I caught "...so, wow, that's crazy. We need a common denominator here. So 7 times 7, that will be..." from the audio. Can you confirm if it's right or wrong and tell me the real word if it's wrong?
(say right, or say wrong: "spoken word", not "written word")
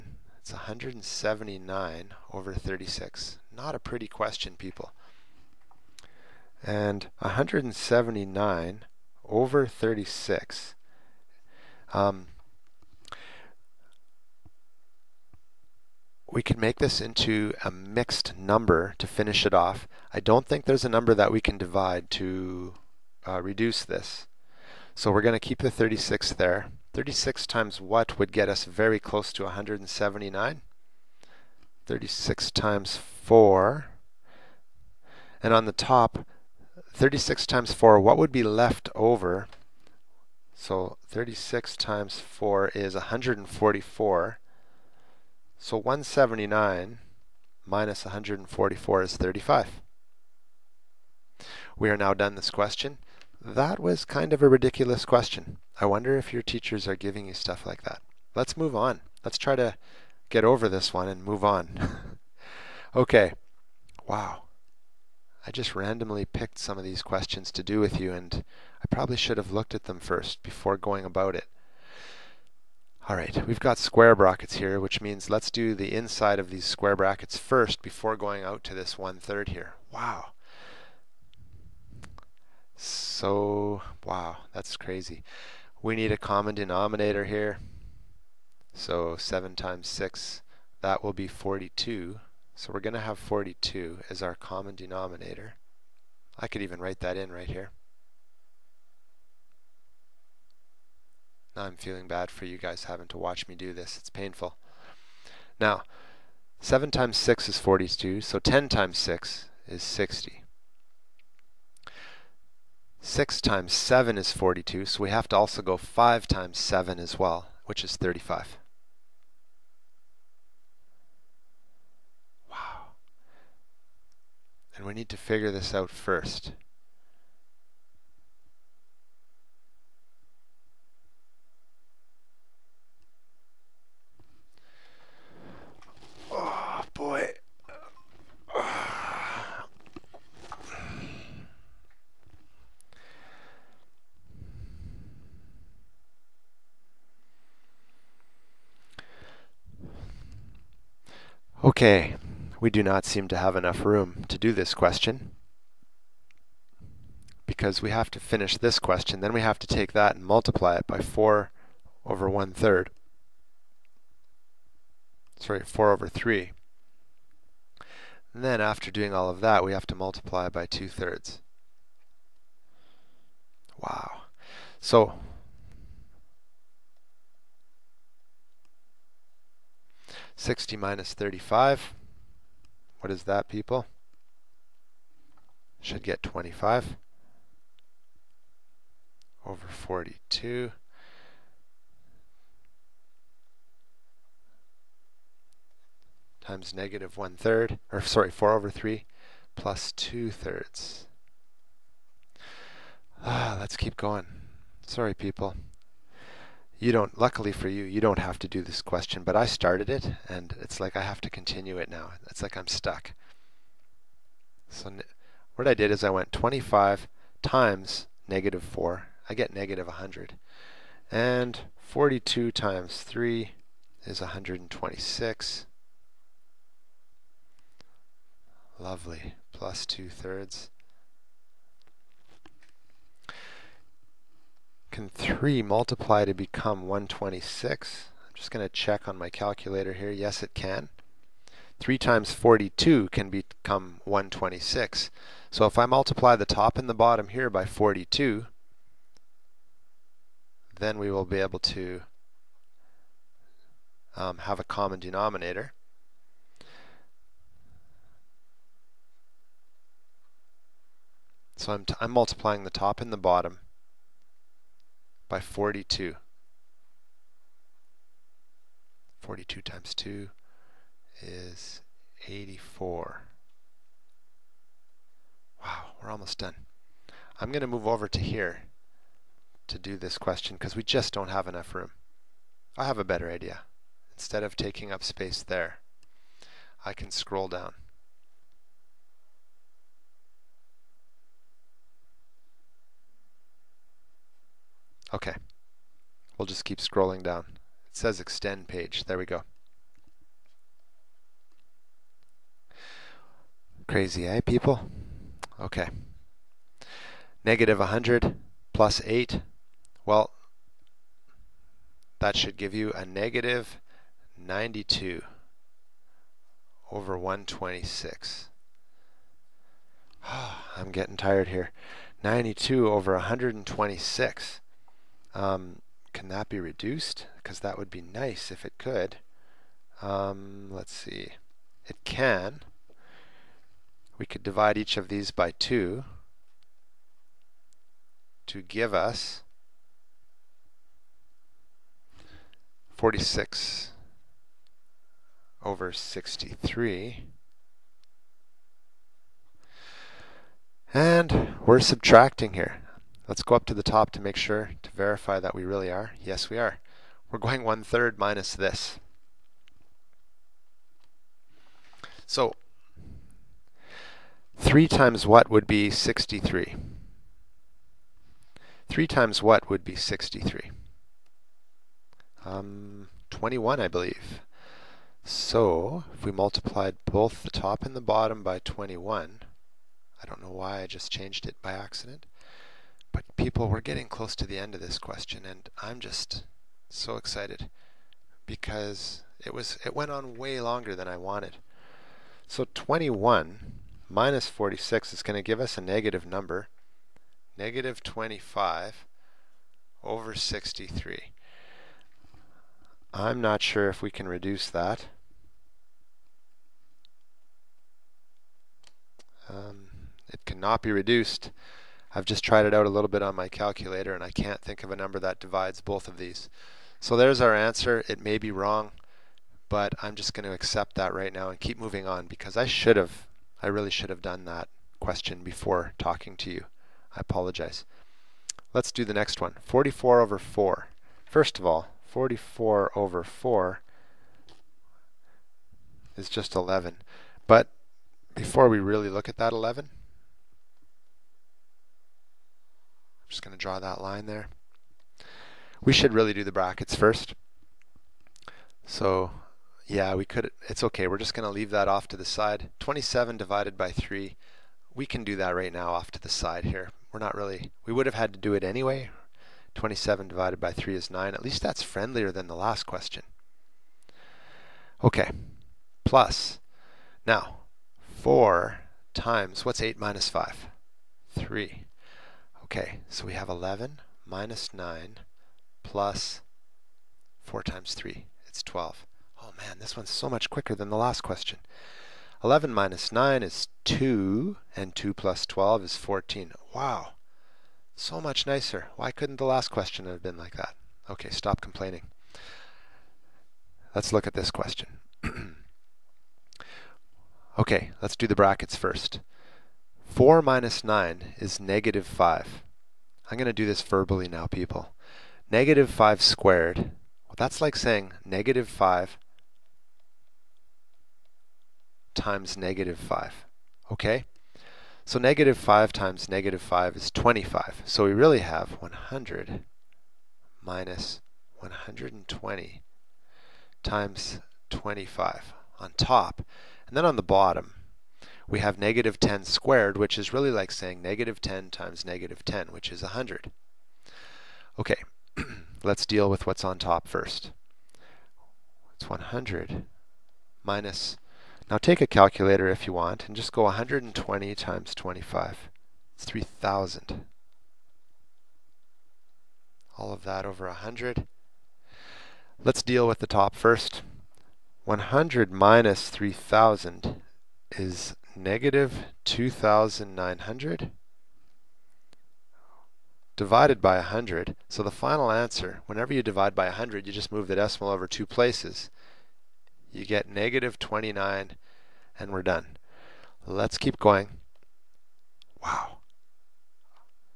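wrong: "6", not "7".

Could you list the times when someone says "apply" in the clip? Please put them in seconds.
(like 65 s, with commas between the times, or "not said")
not said.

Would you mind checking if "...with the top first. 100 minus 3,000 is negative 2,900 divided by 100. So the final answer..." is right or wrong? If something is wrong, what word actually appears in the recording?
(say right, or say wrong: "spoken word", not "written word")
right.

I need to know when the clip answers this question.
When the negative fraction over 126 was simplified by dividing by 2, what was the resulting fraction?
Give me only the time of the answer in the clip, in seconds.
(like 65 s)
342 s.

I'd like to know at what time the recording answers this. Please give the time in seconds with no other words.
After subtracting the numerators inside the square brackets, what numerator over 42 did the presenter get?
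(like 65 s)
185 s.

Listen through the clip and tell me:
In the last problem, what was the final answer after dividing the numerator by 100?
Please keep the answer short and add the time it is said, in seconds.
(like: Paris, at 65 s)
-29, at 570 s.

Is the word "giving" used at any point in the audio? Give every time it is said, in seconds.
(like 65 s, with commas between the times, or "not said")
56 s.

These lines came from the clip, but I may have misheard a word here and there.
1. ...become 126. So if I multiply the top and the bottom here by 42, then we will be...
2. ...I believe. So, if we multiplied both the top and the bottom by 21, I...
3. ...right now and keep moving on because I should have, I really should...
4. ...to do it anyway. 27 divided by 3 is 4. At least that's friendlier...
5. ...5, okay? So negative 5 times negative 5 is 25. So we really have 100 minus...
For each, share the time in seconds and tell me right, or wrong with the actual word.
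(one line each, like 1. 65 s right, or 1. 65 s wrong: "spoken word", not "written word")
1. 243 s right
2. 373 s right
3. 421 s right
4. 458 s wrong: "9", not "4"
5. 512 s right.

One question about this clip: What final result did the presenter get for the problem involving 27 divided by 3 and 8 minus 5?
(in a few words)
14.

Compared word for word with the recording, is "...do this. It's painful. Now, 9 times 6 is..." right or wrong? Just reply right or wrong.
wrong.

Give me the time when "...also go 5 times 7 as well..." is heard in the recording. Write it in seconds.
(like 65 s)
115 s.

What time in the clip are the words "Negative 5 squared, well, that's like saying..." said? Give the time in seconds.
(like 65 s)
505 s.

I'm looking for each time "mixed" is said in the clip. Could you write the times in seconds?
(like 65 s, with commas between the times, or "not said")
17 s.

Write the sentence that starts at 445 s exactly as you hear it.
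We should really do the brackets first.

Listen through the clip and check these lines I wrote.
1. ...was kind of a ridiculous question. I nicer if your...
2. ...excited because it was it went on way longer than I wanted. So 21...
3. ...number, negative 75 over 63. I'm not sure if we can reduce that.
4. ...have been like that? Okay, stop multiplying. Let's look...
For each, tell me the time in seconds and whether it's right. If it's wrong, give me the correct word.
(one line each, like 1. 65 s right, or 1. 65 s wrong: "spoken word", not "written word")
1. 53 s wrong: "wonder", not "nicer"
2. 387 s right
3. 396 s wrong: "25", not "75"
4. 490 s wrong: "complaining", not "multiplying".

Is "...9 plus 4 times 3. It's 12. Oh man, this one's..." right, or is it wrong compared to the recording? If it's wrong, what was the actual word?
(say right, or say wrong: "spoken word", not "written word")
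right.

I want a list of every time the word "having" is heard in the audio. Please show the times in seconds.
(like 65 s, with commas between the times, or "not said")
102 s.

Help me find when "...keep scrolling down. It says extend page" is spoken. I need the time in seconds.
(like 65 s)
296 s.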